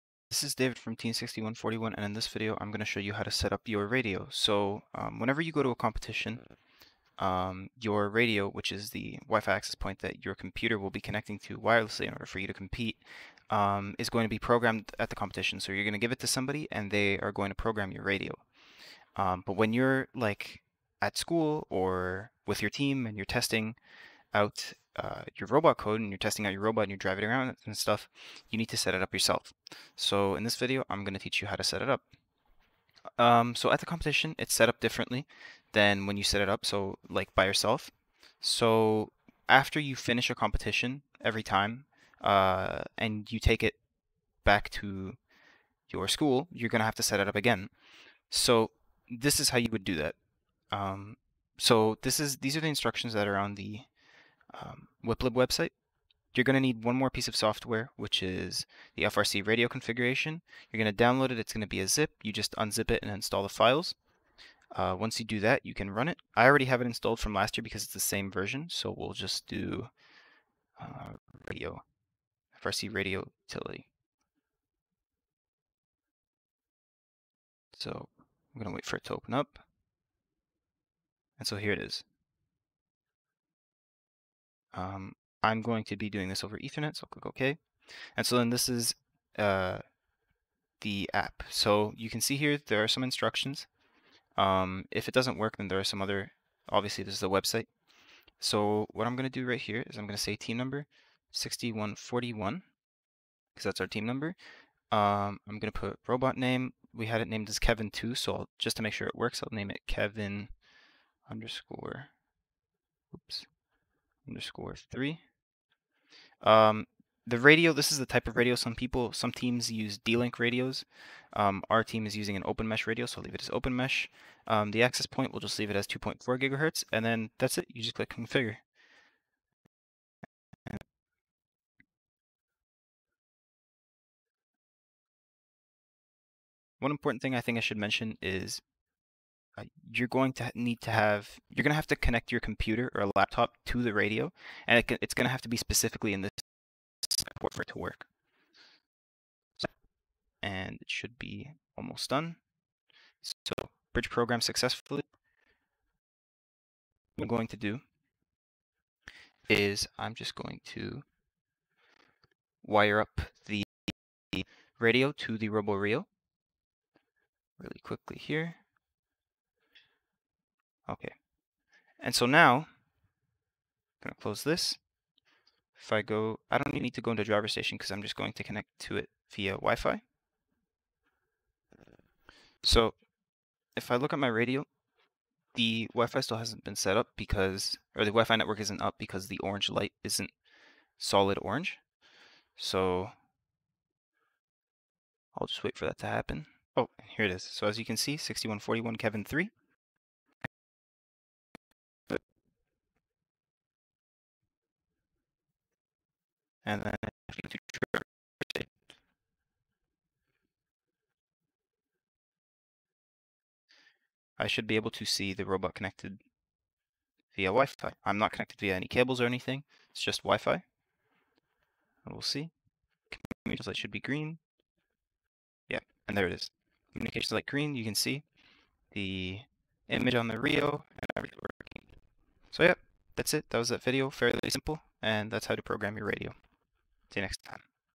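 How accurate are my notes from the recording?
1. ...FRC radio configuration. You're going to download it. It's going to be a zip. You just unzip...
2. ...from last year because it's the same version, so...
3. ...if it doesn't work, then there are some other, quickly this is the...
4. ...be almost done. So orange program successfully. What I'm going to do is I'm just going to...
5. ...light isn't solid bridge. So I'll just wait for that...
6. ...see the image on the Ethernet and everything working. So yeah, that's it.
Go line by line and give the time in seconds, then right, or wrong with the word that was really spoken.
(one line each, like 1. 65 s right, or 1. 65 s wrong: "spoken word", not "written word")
1. 59 s right
2. 67 s right
3. 94 s wrong: "obviously", not "quickly"
4. 151 s wrong: "bridge", not "orange"
5. 189 s wrong: "orange", not "bridge"
6. 227 s wrong: "Rio", not "Ethernet".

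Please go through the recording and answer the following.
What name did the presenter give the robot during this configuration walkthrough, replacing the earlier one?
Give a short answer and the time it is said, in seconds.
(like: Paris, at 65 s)
Kevin_3, at 109 s.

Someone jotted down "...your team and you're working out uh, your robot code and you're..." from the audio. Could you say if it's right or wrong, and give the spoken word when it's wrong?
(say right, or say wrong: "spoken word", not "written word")
wrong: "testing", not "working".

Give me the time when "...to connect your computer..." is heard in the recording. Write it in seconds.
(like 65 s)
141 s.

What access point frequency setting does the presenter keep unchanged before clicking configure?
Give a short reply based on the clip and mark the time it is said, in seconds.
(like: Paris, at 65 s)
2.4 gigahertz, at 125 s.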